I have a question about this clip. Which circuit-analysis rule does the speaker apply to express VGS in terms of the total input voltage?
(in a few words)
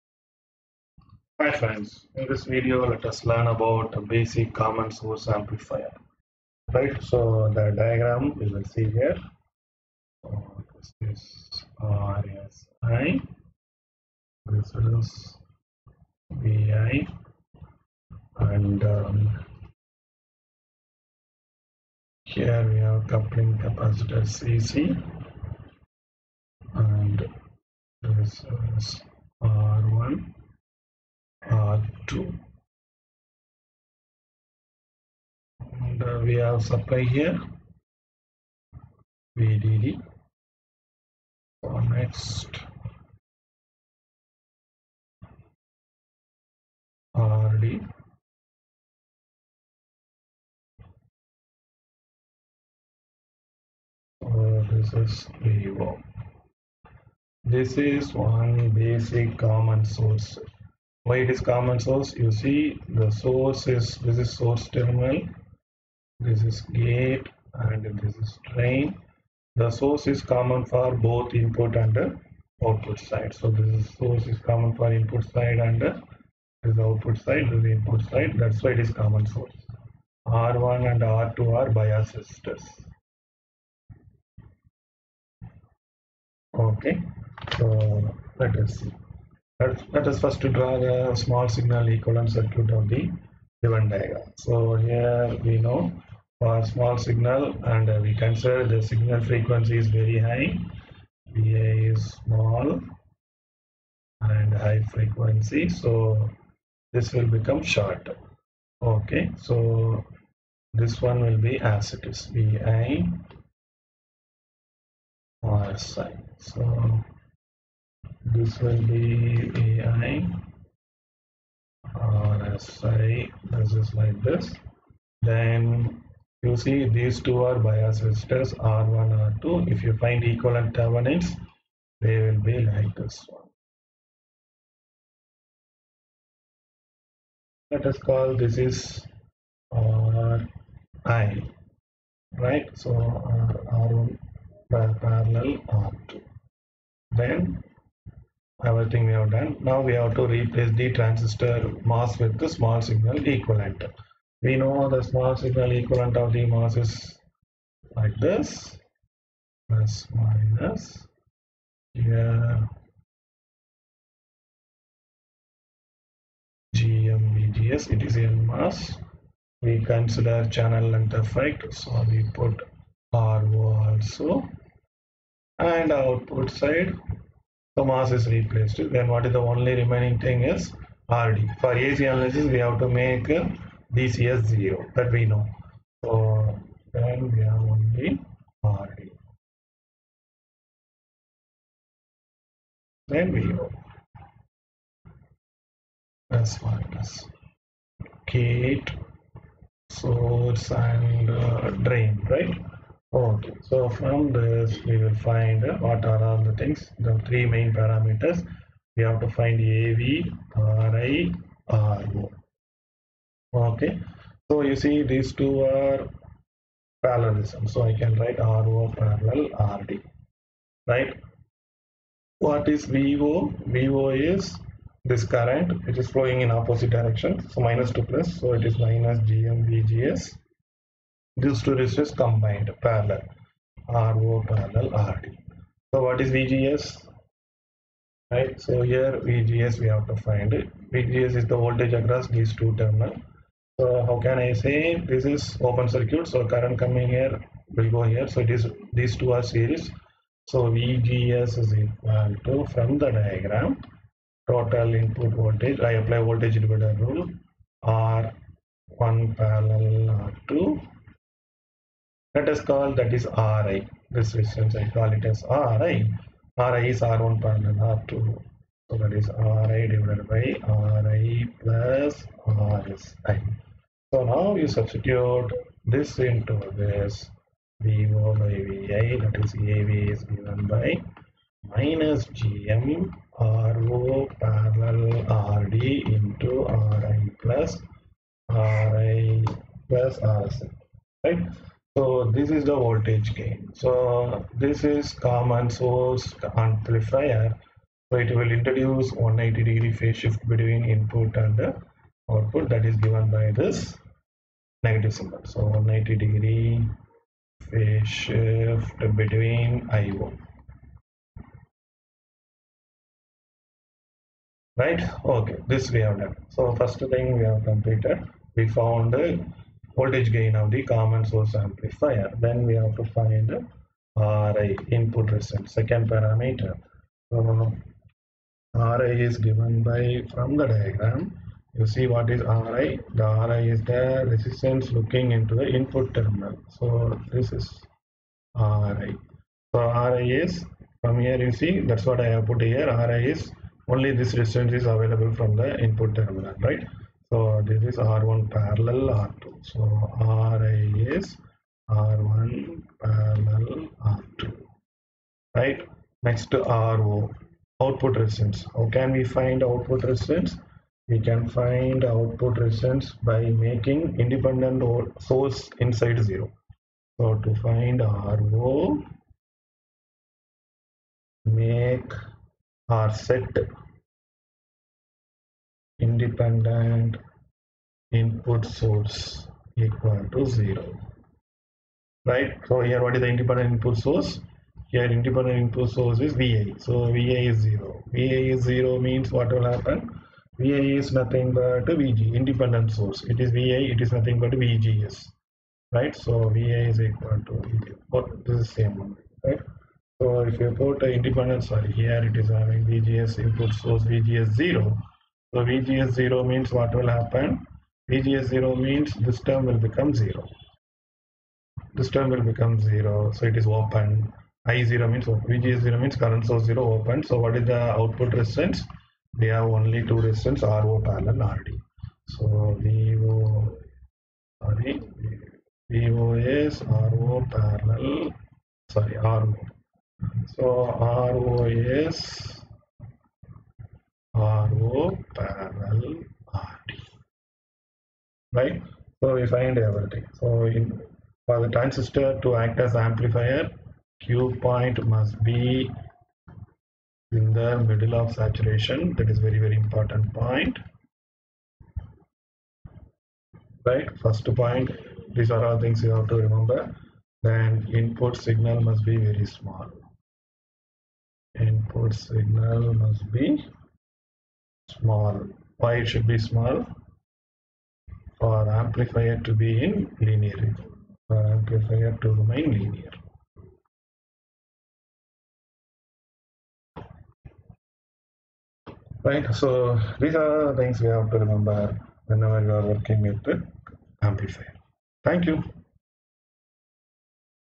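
voltage divider rule.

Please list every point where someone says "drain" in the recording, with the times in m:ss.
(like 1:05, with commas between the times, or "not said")
1:08, 3:21.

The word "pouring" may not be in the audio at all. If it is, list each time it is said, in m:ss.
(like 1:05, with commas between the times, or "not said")
not said.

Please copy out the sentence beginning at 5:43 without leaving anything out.
Ri is only this resistance is available from the input terminal, right?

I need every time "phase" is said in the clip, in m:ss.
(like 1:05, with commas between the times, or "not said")
4:59, 5:07.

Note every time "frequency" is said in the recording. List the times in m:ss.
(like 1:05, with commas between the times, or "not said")
1:39, 1:44.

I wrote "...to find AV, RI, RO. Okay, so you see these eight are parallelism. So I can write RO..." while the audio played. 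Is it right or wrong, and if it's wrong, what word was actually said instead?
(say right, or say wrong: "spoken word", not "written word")
wrong: "two", not "eight".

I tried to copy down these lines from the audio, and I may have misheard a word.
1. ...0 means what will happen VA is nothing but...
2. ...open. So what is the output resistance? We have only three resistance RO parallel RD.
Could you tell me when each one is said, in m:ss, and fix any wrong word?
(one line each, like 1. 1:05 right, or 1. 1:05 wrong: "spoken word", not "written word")
1. 6:28 right
2. 6:56 wrong: "two", not "three".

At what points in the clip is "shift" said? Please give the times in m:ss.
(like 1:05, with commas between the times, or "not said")
5:00, 5:08.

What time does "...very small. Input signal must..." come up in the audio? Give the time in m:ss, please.
7:39.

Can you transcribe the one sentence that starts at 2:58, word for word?
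Then what is the only remaining thing is RD.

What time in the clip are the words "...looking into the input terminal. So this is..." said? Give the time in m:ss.
5:34.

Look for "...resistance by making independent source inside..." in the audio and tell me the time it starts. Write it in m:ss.
6:02.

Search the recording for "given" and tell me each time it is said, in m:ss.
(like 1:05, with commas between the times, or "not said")
1:33, 4:40, 5:02, 5:29.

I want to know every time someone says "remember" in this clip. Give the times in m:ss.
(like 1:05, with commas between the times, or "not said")
7:36, 8:01.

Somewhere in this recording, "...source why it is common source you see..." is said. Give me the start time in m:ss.
0:59.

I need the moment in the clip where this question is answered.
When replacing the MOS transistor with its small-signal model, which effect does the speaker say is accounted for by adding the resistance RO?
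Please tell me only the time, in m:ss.
2:50.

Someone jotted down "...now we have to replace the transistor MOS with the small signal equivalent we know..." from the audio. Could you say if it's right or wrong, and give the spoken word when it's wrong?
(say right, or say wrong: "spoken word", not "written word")
right.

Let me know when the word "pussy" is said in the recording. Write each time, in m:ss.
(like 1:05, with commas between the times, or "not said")
not said.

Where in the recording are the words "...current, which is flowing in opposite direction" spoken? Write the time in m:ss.
3:45.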